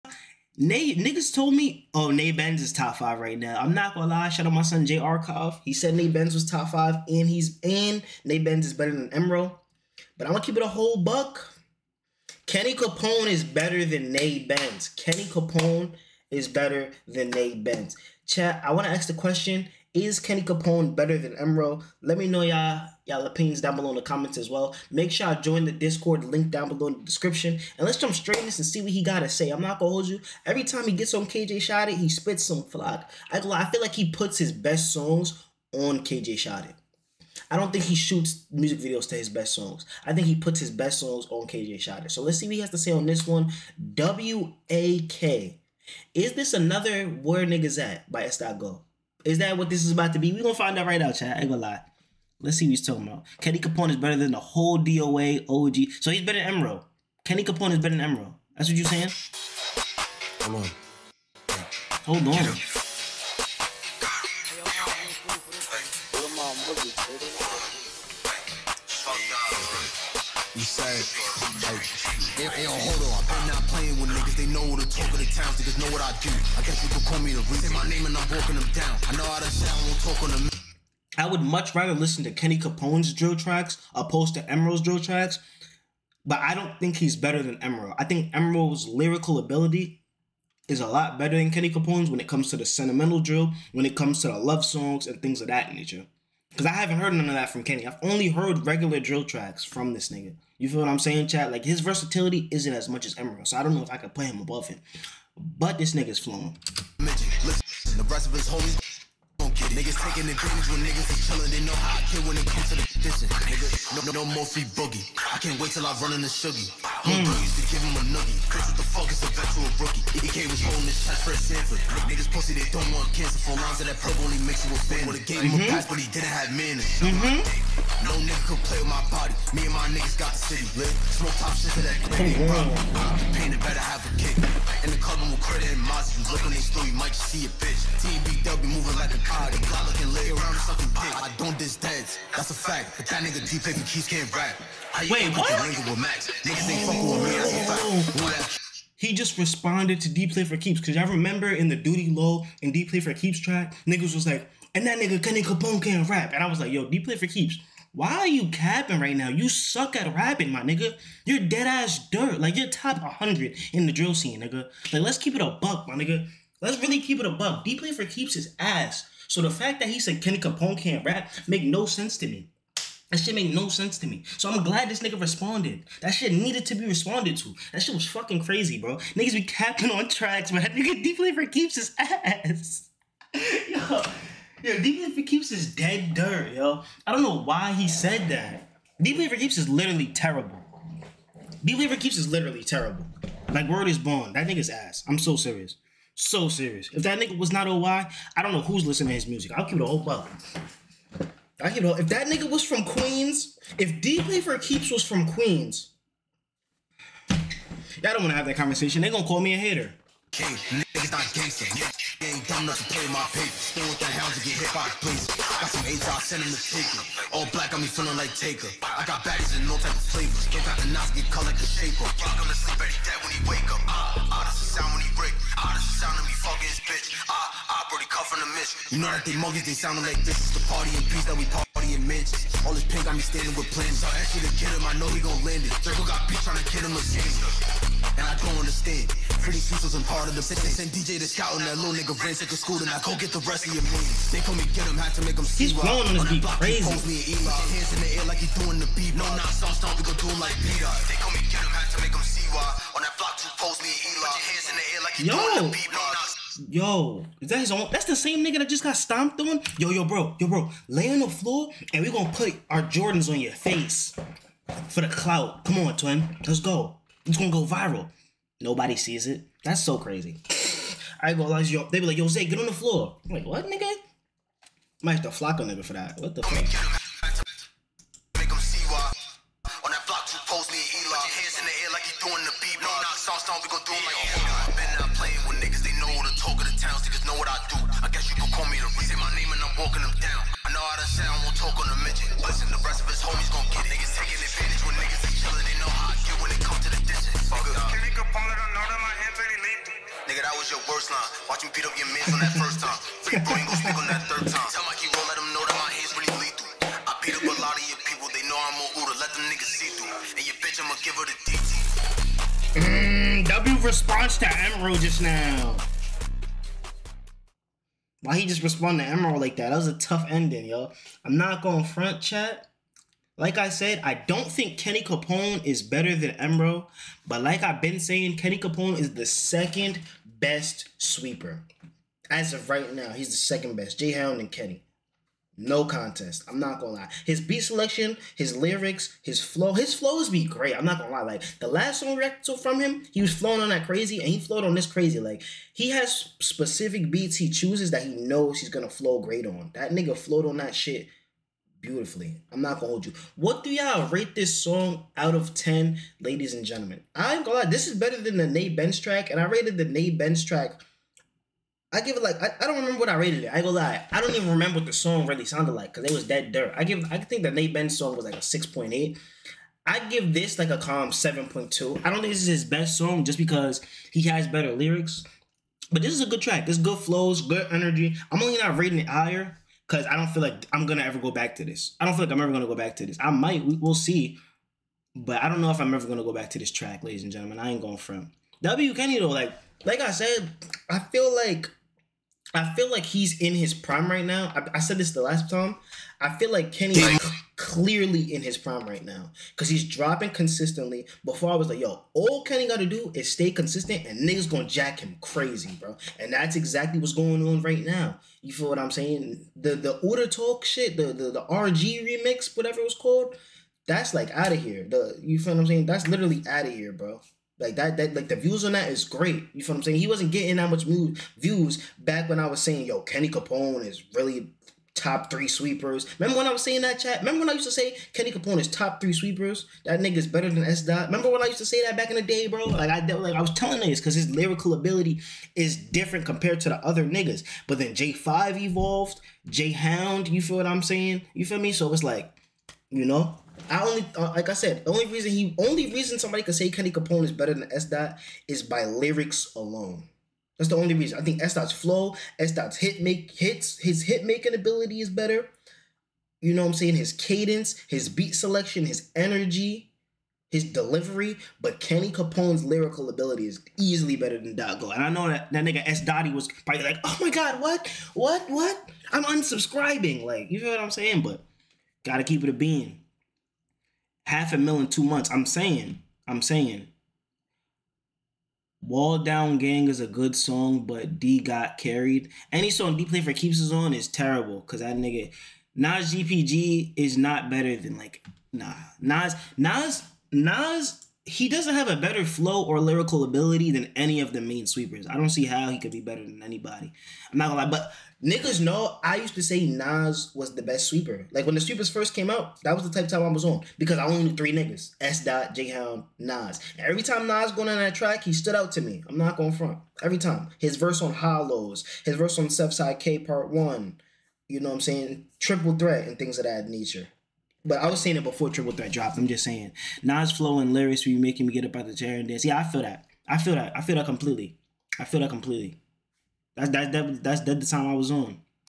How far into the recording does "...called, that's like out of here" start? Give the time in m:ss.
6:52.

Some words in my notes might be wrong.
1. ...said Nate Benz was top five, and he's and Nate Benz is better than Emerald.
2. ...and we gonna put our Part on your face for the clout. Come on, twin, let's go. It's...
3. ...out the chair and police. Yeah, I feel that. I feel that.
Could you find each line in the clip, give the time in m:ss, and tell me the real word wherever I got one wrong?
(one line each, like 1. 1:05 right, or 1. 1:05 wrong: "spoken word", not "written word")
1. 0:05 right
2. 4:21 wrong: "Jordans", not "Part"
3. 8:41 wrong: "dance", not "police".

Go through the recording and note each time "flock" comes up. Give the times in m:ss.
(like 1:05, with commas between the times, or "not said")
0:32, 4:35.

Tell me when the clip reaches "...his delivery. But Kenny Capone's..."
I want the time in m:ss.
7:40.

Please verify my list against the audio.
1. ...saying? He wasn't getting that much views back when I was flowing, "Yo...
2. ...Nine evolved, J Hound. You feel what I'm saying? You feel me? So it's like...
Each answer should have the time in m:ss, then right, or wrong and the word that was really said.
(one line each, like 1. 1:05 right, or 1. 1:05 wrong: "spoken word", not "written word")
1. 6:59 wrong: "saying", not "flowing"
2. 7:18 wrong: "Five", not "Nine".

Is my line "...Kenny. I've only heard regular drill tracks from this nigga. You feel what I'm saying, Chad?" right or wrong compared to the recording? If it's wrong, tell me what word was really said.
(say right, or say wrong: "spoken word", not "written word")
right.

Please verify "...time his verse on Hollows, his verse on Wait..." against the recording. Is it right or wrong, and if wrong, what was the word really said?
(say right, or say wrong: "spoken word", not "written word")
wrong: "Southside", not "Wait".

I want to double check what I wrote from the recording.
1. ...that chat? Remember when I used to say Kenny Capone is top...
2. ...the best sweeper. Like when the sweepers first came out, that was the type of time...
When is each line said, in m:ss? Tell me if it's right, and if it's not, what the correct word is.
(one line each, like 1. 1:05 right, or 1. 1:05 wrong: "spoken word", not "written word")
1. 7:06 right
2. 8:20 right.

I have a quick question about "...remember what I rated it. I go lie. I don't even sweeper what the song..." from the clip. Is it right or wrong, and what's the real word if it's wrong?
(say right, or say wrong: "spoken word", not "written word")
wrong: "remember", not "sweeper".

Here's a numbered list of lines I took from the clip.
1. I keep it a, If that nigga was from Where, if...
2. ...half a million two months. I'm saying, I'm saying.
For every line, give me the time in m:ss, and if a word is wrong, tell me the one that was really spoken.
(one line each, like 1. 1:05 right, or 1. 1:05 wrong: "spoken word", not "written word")
1. 3:21 wrong: "Queens", not "Where"
2. 7:54 right.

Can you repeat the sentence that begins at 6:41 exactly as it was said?
Before I was like, yo, all Kenny got to do is stay consistent and niggas gonna jack him crazy, bro.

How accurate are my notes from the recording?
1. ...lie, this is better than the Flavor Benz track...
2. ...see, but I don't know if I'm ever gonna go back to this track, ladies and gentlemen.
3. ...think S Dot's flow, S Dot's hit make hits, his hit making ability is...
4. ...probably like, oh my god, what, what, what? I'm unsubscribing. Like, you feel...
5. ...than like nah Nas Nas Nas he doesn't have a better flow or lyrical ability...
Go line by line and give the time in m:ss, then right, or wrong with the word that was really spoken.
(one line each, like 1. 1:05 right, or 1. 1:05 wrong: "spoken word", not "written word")
1. 5:57 wrong: "Nate", not "Flavor"
2. 6:23 right
3. 7:31 right
4. 7:46 right
5. 8:07 right.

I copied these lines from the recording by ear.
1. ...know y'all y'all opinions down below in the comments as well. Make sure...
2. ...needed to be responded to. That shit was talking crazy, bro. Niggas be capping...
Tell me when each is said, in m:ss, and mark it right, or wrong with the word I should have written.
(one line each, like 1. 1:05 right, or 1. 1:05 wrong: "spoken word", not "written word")
1. 0:22 right
2. 2:56 wrong: "fucking", not "talking".